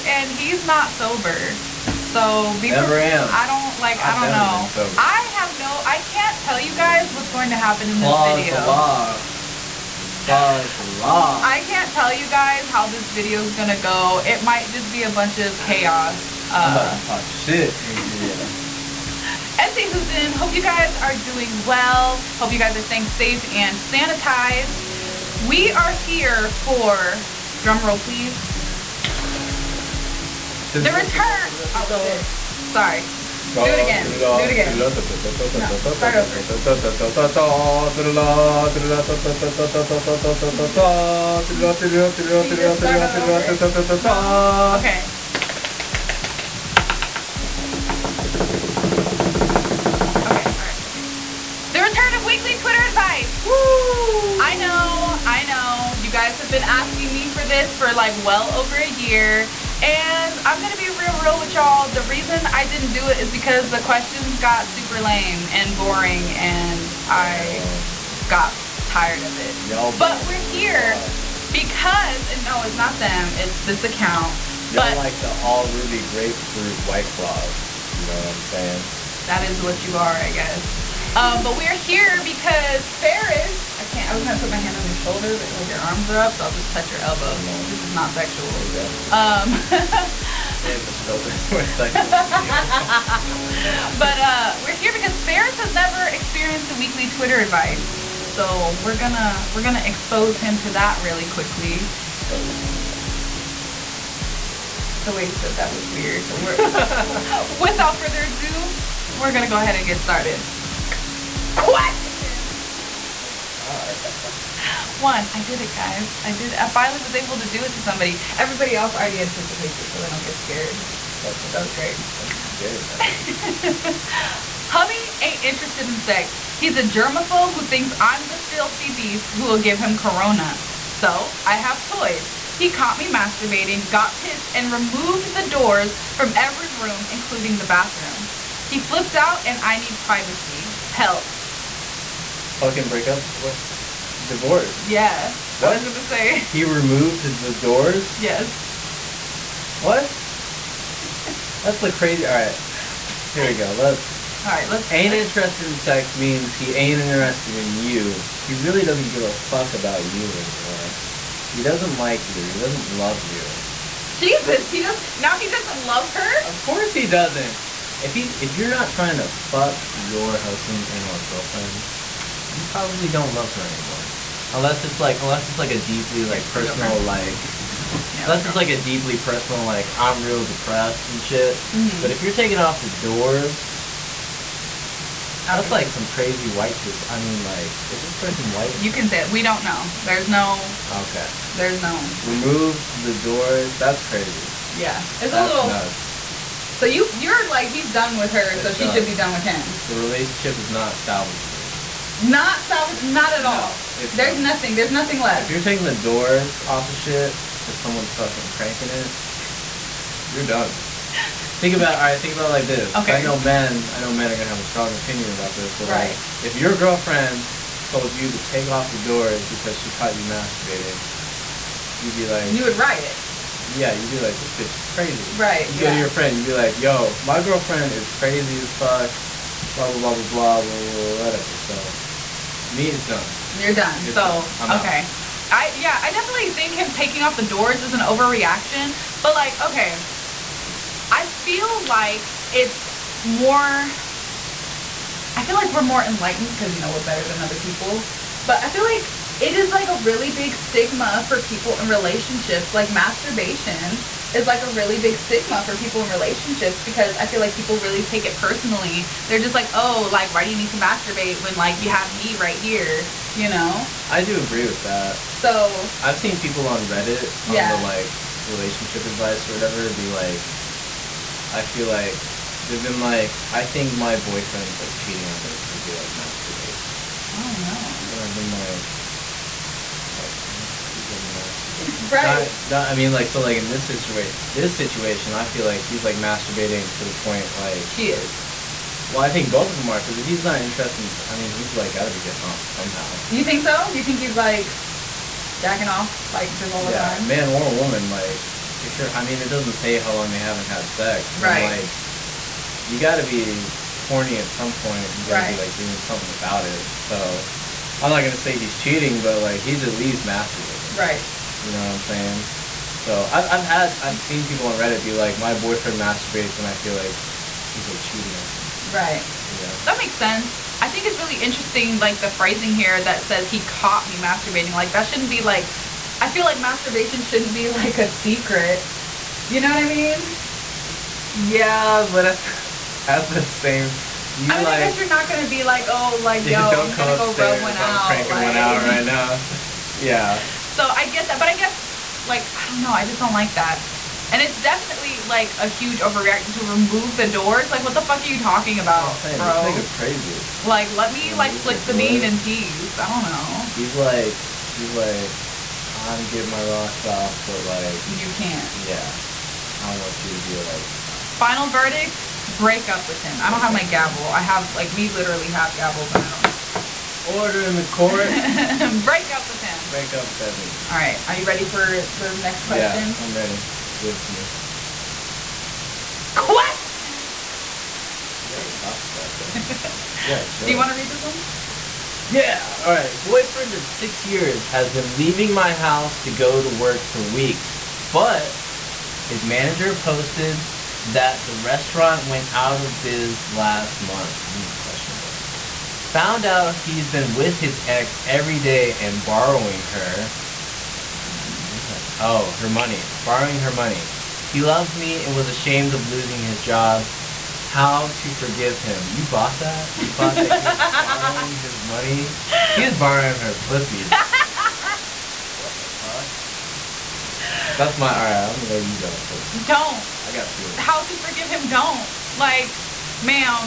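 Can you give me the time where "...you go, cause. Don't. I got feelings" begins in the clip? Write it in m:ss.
6:58.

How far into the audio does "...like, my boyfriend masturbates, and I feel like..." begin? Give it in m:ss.
5:15.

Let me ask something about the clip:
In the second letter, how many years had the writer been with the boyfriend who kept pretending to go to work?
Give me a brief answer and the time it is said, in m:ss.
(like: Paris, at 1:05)
6, at 6:23.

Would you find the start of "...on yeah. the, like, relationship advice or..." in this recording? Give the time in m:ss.
4:27.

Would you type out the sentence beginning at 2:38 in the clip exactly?
He really doesn't give a fuck about you anymore.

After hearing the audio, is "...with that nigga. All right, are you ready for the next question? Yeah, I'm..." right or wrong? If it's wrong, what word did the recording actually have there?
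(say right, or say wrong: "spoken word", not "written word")
right.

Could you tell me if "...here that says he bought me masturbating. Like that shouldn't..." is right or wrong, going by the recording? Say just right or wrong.
wrong.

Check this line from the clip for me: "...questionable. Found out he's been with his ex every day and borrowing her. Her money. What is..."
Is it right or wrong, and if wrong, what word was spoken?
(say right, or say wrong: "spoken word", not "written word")
right.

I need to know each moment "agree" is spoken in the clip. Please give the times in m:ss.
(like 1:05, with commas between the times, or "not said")
4:24.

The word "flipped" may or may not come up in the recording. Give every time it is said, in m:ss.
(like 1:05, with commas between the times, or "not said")
2:18.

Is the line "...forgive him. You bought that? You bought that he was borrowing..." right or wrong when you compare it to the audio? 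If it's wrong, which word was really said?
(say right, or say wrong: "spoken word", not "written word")
right.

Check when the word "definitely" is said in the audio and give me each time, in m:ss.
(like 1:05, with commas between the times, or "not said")
3:56, 5:44.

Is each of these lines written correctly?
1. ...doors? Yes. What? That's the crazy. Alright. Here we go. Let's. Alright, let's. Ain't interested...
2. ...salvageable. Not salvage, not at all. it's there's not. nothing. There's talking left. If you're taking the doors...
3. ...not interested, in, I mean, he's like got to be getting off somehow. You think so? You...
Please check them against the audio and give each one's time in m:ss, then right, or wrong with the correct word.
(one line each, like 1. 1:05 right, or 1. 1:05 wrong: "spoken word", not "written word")
1. 2:27 right
2. 3:20 wrong: "nothing", not "talking"
3. 4:50 right.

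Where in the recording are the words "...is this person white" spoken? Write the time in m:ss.
3:07.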